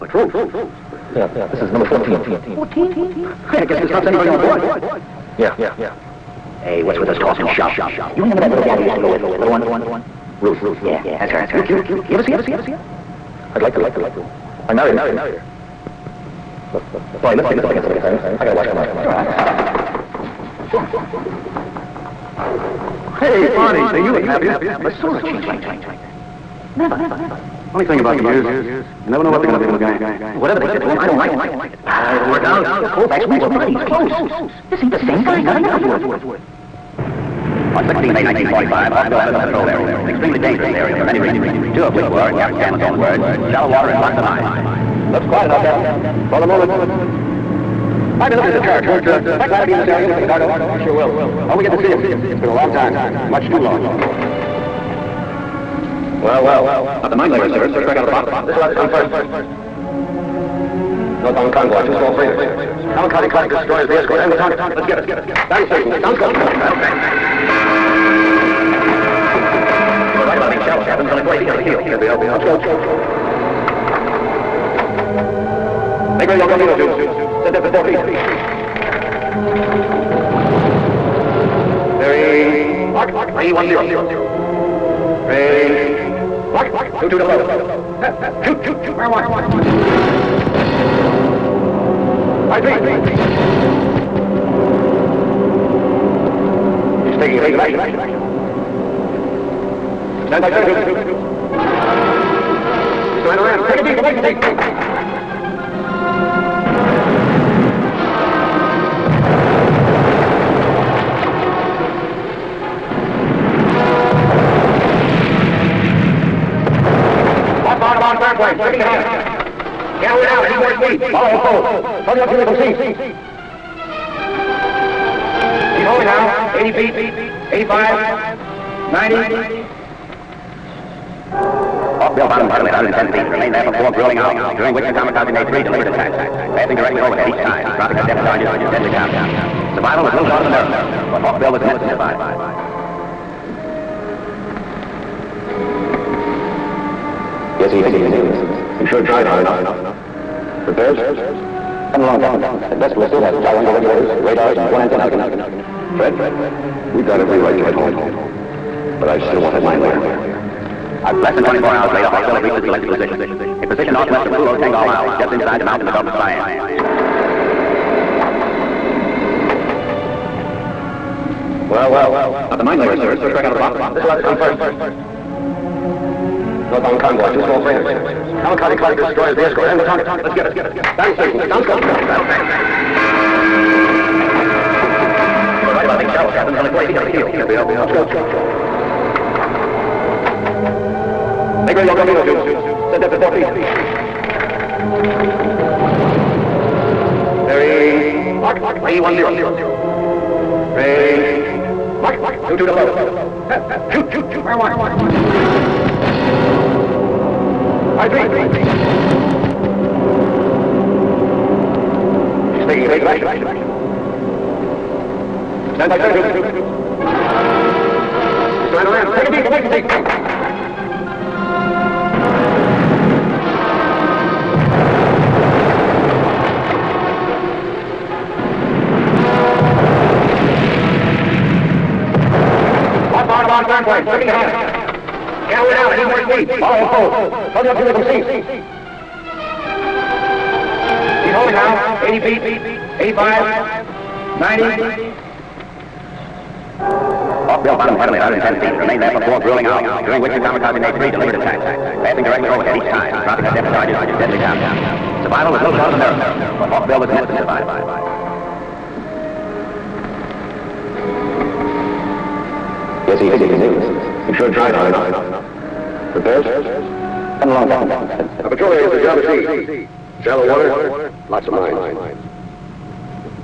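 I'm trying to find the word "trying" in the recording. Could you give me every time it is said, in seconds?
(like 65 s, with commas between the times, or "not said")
103 s, 218 s.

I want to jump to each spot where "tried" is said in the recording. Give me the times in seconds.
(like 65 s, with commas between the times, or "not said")
149 s, 264 s.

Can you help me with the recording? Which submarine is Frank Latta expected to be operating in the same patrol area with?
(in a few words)
Lagarto.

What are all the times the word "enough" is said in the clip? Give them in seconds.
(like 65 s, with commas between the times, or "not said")
45 s, 149 s, 264 s.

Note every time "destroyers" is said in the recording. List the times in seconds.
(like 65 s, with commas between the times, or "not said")
63 s, 178 s.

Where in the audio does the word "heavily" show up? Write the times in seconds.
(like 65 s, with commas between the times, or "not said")
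132 s, 247 s.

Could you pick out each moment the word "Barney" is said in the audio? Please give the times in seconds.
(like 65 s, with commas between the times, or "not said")
17 s, 23 s.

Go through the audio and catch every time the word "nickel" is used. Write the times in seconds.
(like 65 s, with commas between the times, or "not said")
35 s.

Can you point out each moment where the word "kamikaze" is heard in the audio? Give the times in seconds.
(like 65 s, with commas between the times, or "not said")
62 s, 134 s, 178 s, 250 s.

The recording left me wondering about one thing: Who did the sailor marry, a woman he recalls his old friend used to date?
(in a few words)
Ruth.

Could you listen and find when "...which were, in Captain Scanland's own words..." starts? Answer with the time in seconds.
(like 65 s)
41 s.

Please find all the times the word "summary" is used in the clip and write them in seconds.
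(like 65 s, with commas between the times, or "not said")
not said.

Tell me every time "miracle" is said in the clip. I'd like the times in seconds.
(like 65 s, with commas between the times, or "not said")
140 s, 255 s.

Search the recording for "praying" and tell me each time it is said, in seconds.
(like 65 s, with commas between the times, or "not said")
not said.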